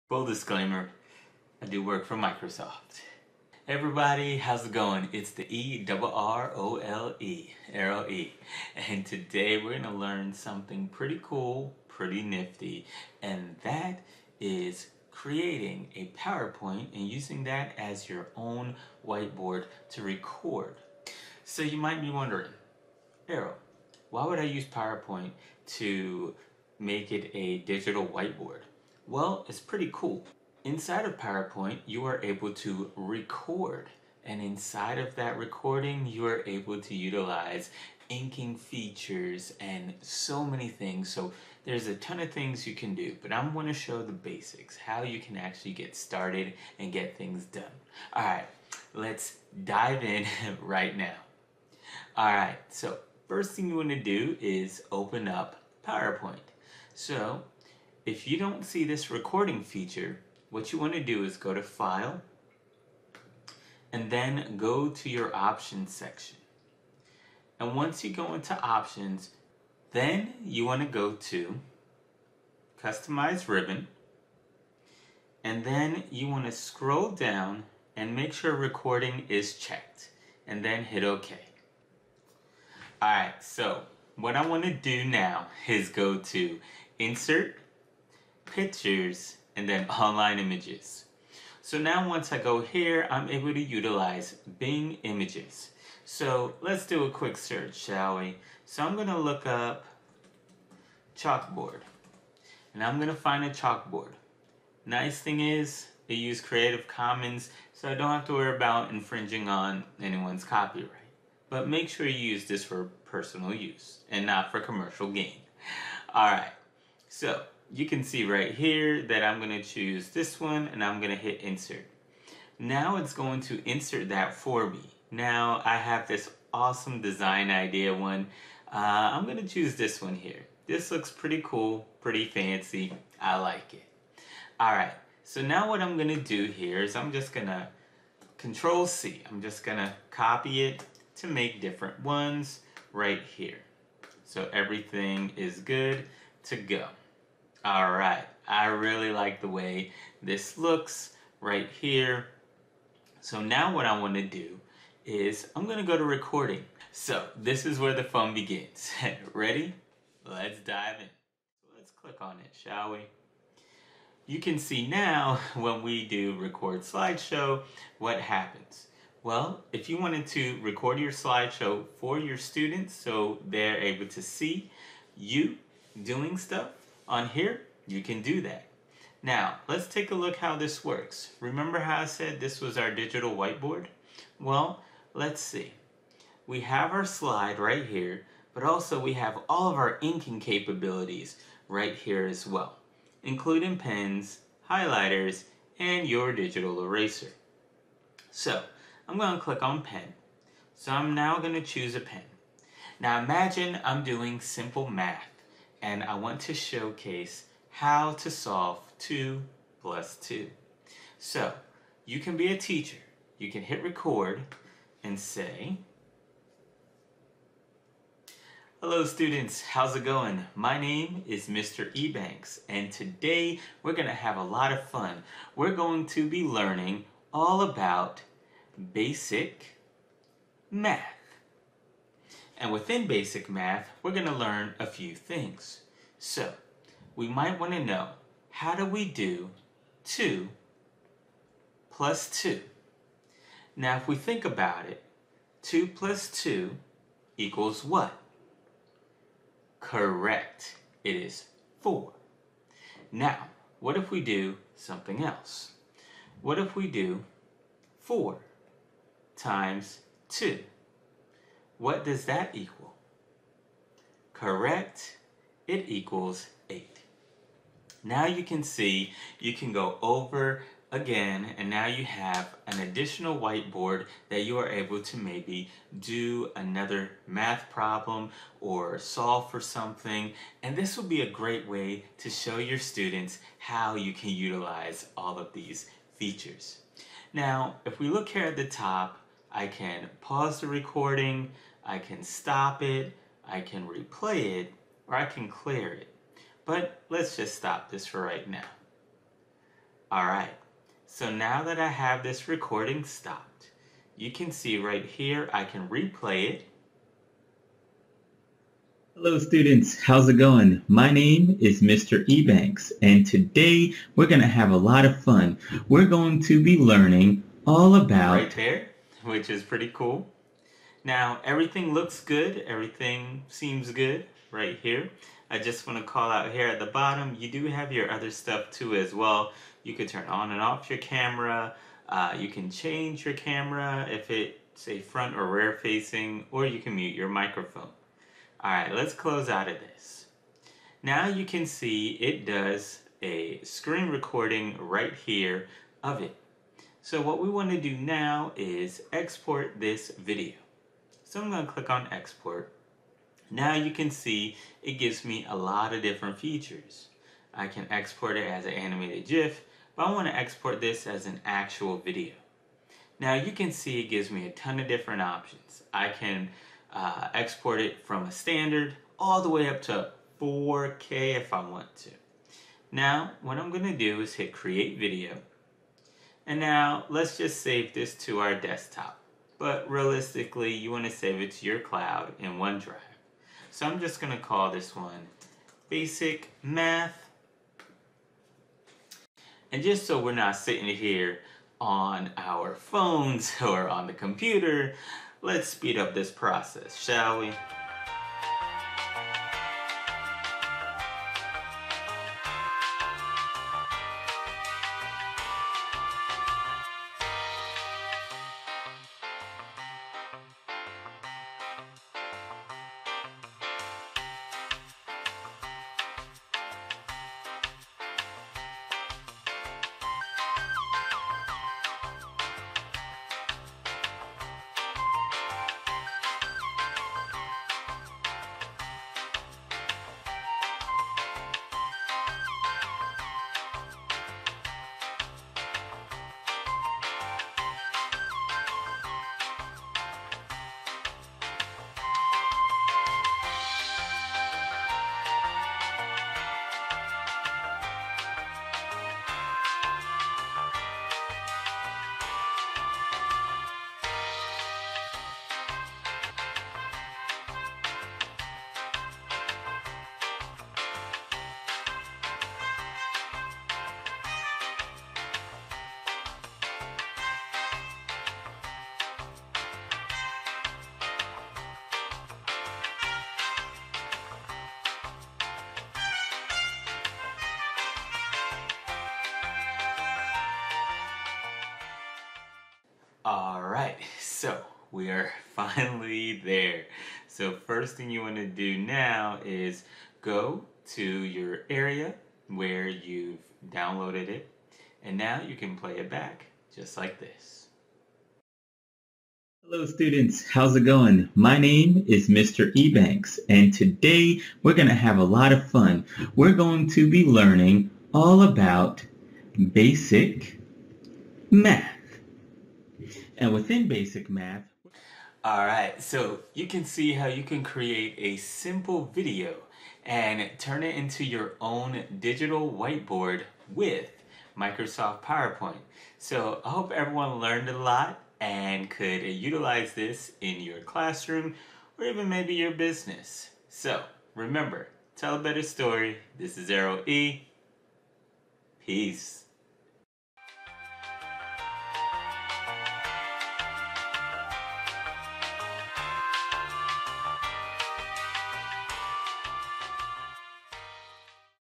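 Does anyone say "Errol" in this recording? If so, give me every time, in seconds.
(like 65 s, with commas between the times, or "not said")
5 s, 23 s, 536 s.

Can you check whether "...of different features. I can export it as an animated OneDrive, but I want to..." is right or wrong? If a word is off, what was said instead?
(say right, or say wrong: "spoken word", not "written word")
wrong: "GIF", not "OneDrive".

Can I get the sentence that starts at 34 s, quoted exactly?
And inside of that recording, you are able to utilize inking features and so many things.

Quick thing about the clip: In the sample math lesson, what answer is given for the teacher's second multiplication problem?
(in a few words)
8.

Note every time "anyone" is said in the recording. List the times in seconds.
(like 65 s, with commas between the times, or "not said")
110 s.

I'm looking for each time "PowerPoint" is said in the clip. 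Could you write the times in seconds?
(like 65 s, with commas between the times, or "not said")
16 s, 24 s, 31 s, 55 s, 525 s.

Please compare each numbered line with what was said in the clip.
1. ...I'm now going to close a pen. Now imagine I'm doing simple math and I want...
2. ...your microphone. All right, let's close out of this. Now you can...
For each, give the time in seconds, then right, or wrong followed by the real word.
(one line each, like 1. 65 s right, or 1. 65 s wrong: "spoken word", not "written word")
1. 200 s wrong: "choose", not "close"
2. 337 s right.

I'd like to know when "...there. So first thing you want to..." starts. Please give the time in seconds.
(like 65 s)
486 s.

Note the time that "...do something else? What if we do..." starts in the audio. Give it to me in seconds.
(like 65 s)
254 s.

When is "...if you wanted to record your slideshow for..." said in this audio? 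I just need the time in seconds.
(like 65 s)
169 s.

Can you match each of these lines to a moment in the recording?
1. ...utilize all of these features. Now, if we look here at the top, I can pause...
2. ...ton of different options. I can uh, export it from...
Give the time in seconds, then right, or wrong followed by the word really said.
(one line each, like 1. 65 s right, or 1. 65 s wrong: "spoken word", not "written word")
1. 284 s right
2. 364 s right.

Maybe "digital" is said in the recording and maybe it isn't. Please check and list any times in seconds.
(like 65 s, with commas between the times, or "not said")
27 s, 182 s, 196 s, 522 s.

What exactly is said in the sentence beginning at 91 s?
So now once I go here, I'm able to utilize Bing Images.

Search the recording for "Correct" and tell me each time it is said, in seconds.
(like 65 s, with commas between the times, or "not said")
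249 s, 264 s.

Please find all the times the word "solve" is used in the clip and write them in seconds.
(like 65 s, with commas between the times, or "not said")
208 s, 278 s.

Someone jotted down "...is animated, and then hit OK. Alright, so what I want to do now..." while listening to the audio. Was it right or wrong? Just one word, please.
wrong.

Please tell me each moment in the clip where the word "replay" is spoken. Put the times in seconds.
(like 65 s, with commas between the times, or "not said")
293 s, 305 s.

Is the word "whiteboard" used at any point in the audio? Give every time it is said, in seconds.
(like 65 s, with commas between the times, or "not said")
19 s, 28 s, 183 s, 273 s, 522 s.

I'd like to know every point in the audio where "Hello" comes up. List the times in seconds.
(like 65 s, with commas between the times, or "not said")
218 s, 309 s, 499 s.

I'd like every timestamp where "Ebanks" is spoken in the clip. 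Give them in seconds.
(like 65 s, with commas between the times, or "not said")
221 s, 312 s, 502 s.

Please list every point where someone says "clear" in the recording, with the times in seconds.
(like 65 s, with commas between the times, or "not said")
295 s.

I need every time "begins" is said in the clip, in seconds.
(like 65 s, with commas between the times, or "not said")
158 s.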